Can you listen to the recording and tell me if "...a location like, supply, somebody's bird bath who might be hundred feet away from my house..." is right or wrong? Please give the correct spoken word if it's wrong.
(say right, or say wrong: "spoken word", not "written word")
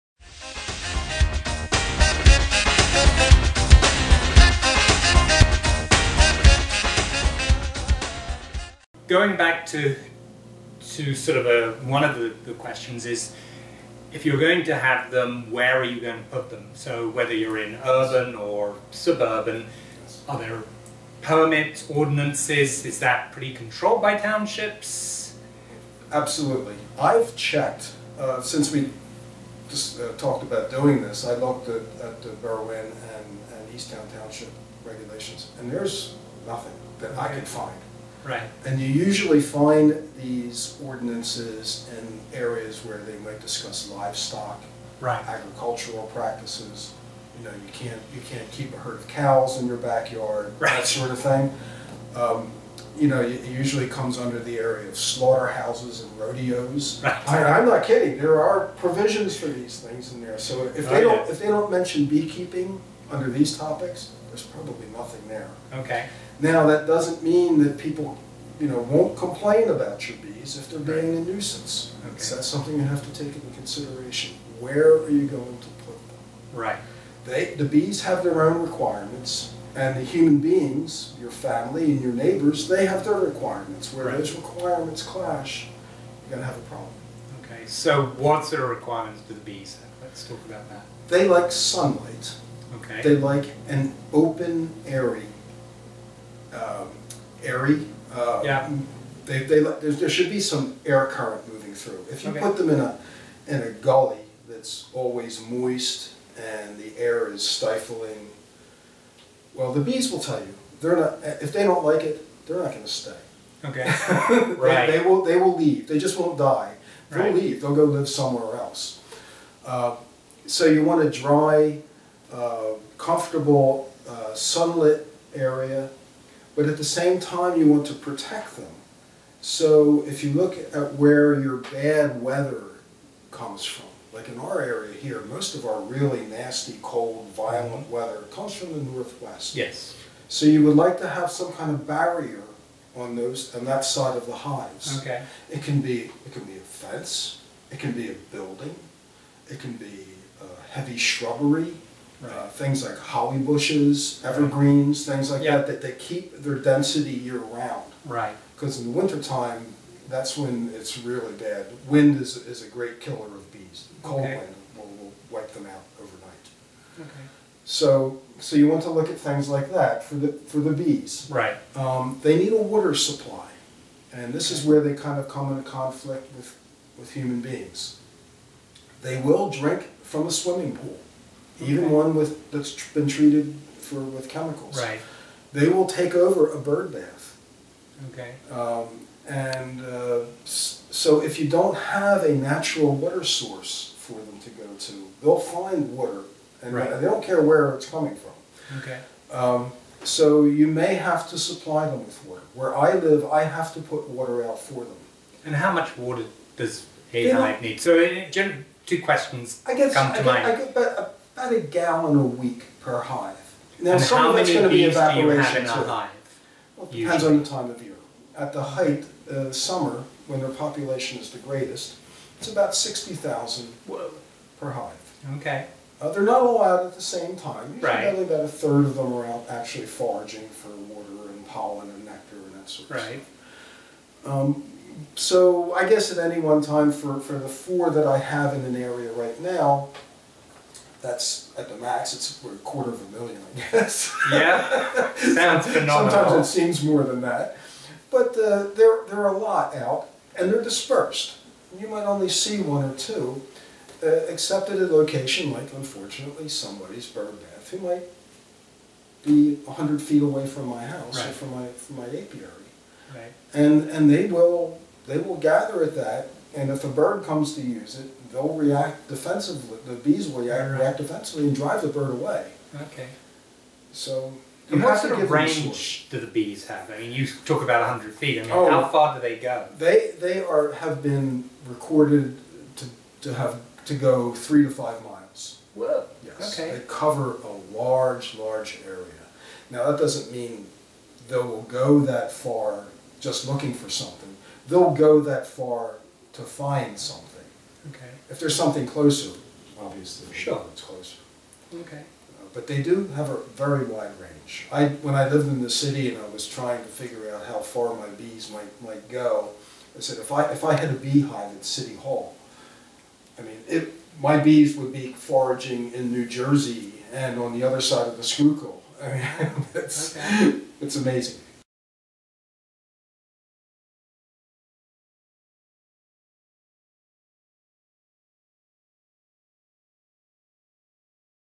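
wrong: "unfortunately", not "supply".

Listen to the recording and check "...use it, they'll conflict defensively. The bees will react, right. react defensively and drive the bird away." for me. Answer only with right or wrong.
wrong.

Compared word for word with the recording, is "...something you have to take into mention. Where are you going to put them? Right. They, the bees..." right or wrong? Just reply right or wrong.
wrong.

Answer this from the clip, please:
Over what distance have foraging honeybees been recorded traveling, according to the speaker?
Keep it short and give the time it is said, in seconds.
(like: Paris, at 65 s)
3 to 5 miles, at 284 s.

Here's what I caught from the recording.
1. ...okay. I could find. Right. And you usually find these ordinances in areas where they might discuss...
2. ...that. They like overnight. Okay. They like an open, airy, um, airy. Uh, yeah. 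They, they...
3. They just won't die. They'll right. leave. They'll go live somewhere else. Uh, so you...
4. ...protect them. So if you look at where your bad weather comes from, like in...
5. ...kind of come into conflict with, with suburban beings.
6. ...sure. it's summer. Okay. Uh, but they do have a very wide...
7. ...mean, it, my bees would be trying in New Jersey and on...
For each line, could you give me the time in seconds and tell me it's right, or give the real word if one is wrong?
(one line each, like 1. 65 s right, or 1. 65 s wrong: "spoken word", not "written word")
1. 37 s right
2. 90 s wrong: "sunlight", not "overnight"
3. 115 s right
4. 127 s right
5. 174 s wrong: "human", not "suburban"
6. 300 s wrong: "closer", not "summer"
7. 313 s wrong: "foraging", not "trying".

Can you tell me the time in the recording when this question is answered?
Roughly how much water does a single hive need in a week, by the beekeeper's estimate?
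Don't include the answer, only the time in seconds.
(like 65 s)
211 s.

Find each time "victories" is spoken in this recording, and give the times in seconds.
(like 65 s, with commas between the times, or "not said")
not said.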